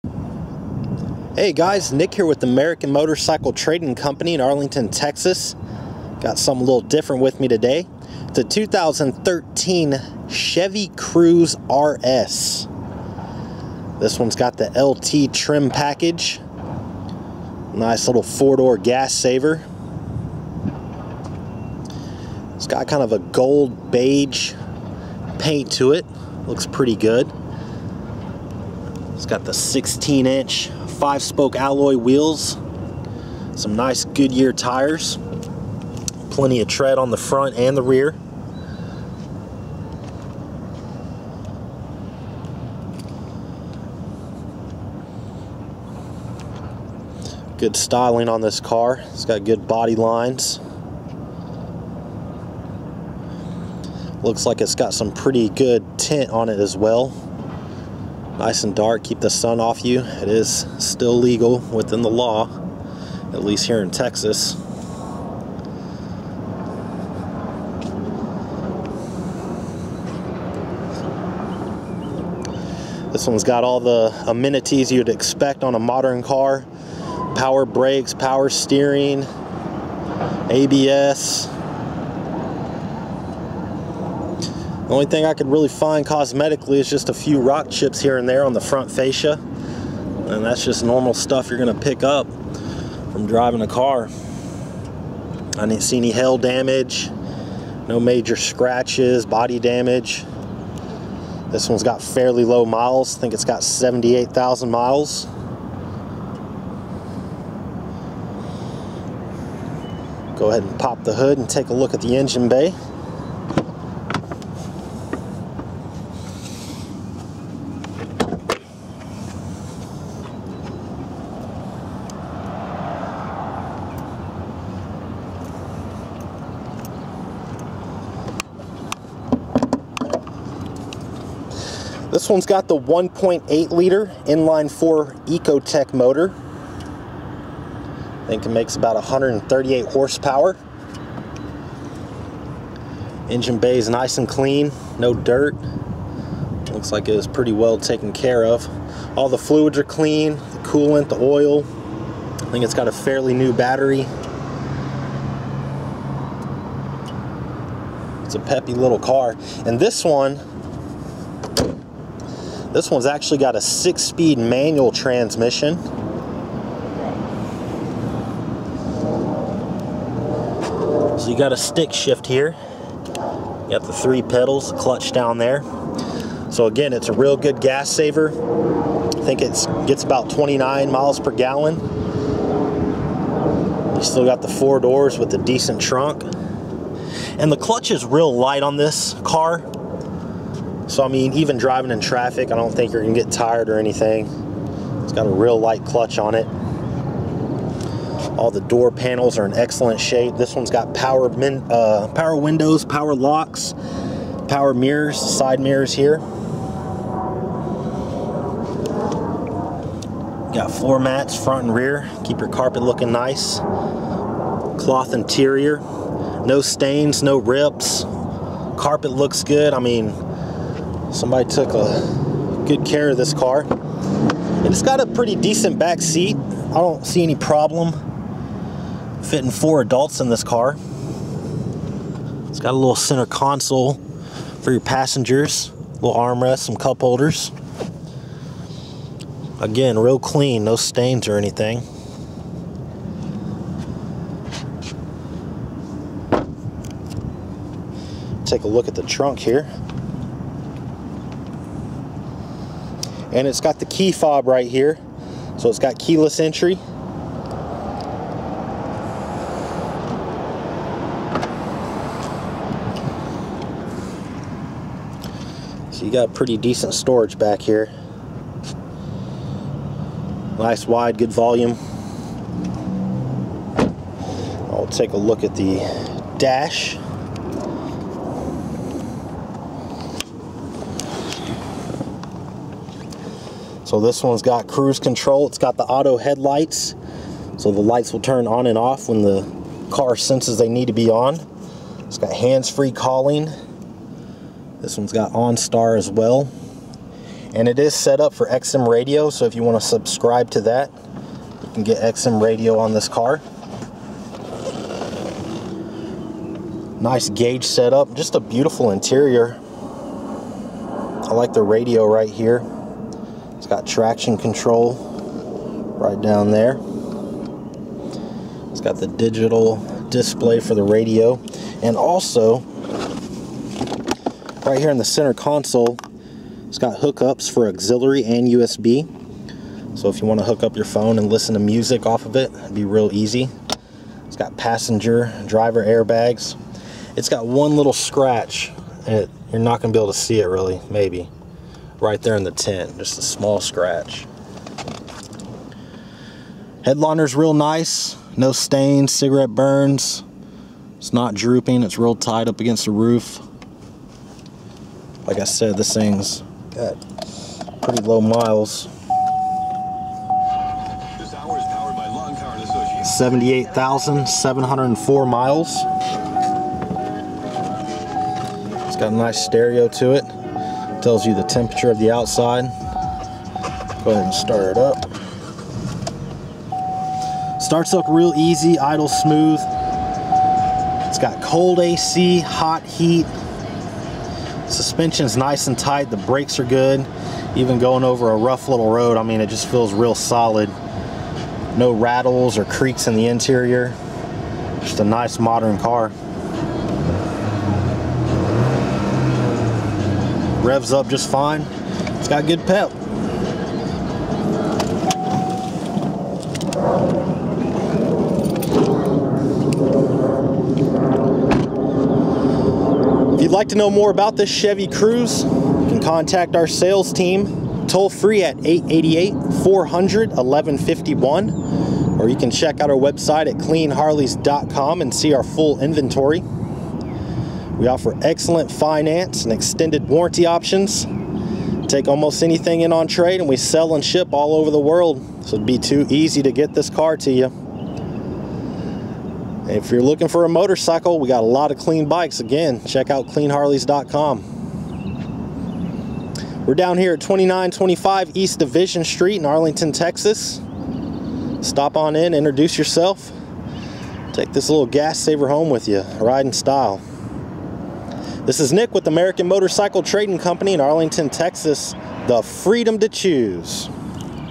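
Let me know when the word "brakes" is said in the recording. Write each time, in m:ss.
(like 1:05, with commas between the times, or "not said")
1:17, 6:26.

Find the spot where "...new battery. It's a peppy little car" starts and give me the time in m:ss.
2:33.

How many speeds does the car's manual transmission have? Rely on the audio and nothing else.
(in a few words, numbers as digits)
6.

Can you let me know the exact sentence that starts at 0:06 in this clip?
Got something a little different with me today.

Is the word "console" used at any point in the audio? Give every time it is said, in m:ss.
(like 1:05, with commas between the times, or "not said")
3:53, 5:25.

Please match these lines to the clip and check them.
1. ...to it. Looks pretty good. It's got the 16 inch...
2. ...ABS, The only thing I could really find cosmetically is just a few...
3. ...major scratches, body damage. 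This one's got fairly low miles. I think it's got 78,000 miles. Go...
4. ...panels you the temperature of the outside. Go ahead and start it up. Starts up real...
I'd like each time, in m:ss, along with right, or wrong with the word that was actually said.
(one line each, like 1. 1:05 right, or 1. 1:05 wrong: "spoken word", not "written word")
1. 0:25 right
2. 1:20 right
3. 1:38 right
4. 6:11 wrong: "tells", not "panels".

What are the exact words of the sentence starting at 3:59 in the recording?
Again, real clean, no stains or anything.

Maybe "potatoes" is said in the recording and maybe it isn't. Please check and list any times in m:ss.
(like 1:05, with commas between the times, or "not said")
not said.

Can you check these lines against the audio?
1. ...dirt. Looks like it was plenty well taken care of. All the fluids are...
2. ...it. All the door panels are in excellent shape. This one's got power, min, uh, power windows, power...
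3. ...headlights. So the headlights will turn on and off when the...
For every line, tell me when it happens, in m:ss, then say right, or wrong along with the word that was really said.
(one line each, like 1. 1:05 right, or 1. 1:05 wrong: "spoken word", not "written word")
1. 2:25 wrong: "pretty", not "plenty"
2. 3:16 right
3. 4:46 wrong: "lights", not "headlights".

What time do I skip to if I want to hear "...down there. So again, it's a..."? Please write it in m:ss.
2:55.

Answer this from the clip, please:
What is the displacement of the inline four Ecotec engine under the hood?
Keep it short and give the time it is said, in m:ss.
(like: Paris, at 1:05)
1.8 liter, at 2:12.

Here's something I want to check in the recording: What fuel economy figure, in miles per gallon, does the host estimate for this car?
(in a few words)
29.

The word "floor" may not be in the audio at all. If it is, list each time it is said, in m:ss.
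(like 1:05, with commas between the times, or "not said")
3:30.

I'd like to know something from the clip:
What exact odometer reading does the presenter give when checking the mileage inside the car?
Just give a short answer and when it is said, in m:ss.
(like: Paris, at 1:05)
78,704 miles, at 6:03.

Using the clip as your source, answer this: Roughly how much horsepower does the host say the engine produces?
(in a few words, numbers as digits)
138.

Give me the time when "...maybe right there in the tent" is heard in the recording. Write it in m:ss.
5:40.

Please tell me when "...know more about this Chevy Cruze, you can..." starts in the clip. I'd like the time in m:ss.
6:53.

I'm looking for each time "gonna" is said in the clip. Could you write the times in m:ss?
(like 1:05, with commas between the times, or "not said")
1:31.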